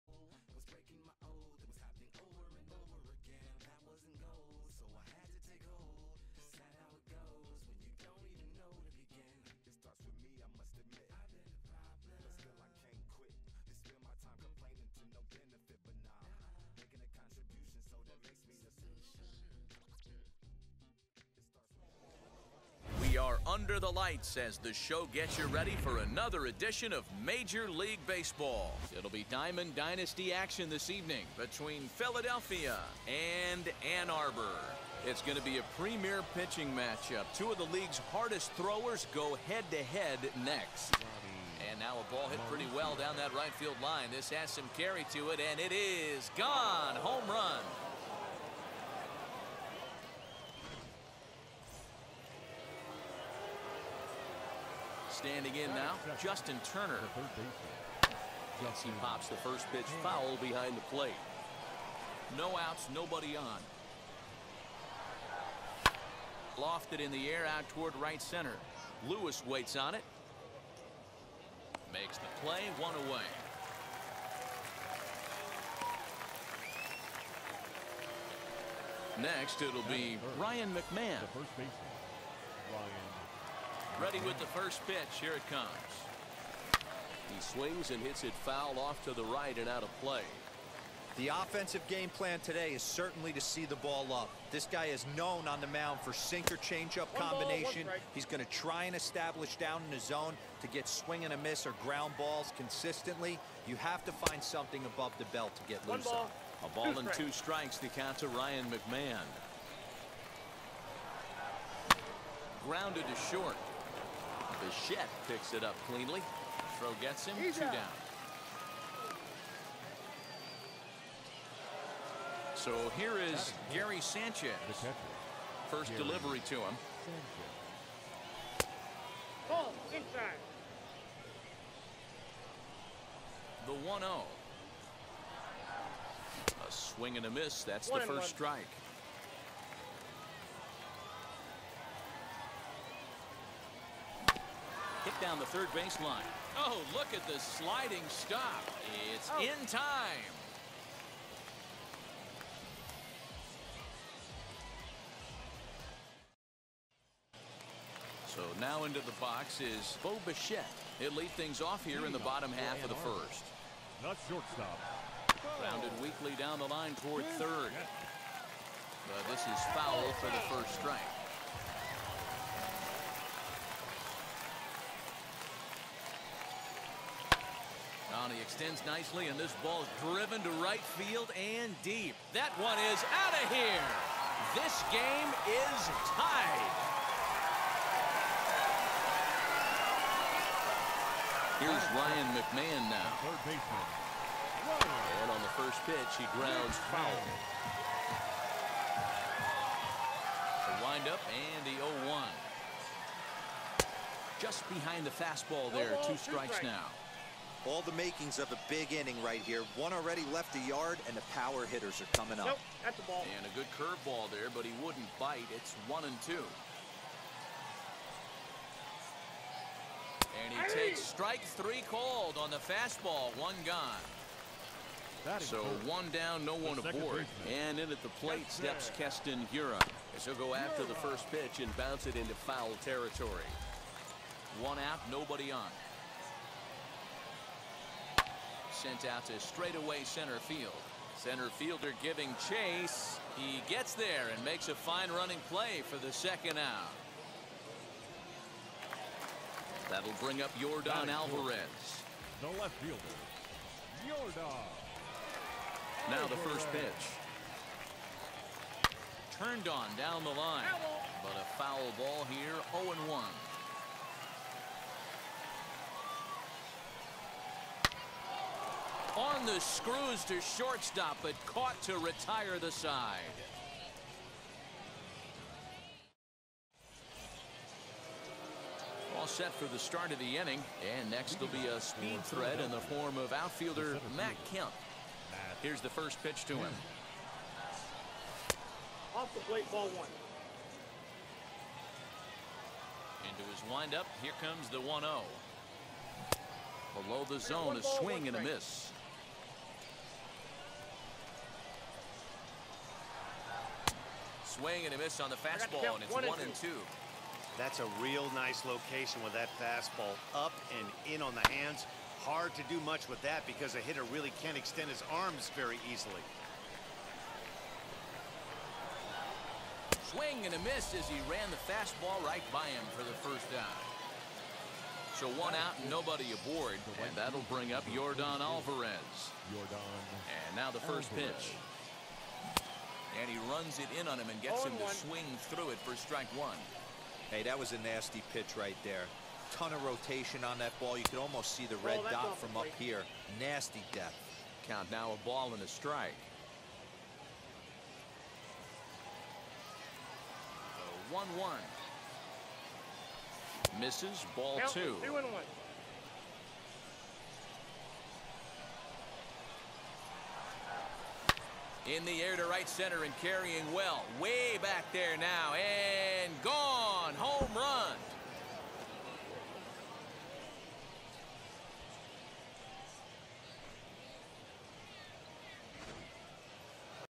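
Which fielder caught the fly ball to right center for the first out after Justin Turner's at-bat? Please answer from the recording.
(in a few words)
Lewis.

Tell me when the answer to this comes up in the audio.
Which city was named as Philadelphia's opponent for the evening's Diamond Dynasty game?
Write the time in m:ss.
0:33.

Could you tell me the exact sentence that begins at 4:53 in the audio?
Into his windup, here comes the 1-0.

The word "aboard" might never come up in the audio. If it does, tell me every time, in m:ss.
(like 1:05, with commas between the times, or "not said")
3:46, 5:26.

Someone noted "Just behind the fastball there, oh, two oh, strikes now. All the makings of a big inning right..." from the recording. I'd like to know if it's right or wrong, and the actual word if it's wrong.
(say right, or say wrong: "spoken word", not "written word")
right.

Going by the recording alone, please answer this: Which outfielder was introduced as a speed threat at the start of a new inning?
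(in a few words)
Matt Kemp.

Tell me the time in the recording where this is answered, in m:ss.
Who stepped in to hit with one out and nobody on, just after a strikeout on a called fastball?
3:48.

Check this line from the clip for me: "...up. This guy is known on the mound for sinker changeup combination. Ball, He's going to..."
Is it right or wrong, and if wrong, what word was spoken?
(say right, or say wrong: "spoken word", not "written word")
right.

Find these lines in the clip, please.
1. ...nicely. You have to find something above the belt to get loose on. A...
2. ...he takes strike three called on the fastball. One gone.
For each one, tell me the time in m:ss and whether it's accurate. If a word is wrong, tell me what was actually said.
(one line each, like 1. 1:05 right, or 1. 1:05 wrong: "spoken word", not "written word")
1. 1:42 wrong: "consistently", not "nicely"
2. 3:40 right.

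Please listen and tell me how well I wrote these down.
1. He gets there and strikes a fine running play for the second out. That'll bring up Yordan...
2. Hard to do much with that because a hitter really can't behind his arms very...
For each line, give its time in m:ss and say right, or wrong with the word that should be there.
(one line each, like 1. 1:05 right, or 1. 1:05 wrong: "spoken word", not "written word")
1. 4:03 wrong: "makes", not "strikes"
2. 5:12 wrong: "extend", not "behind".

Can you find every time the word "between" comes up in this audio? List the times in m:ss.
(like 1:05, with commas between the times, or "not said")
0:31.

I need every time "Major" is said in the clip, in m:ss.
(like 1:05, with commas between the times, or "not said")
0:27.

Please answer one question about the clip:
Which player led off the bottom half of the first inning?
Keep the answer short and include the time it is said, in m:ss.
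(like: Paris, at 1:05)
Bo Bichette, at 2:40.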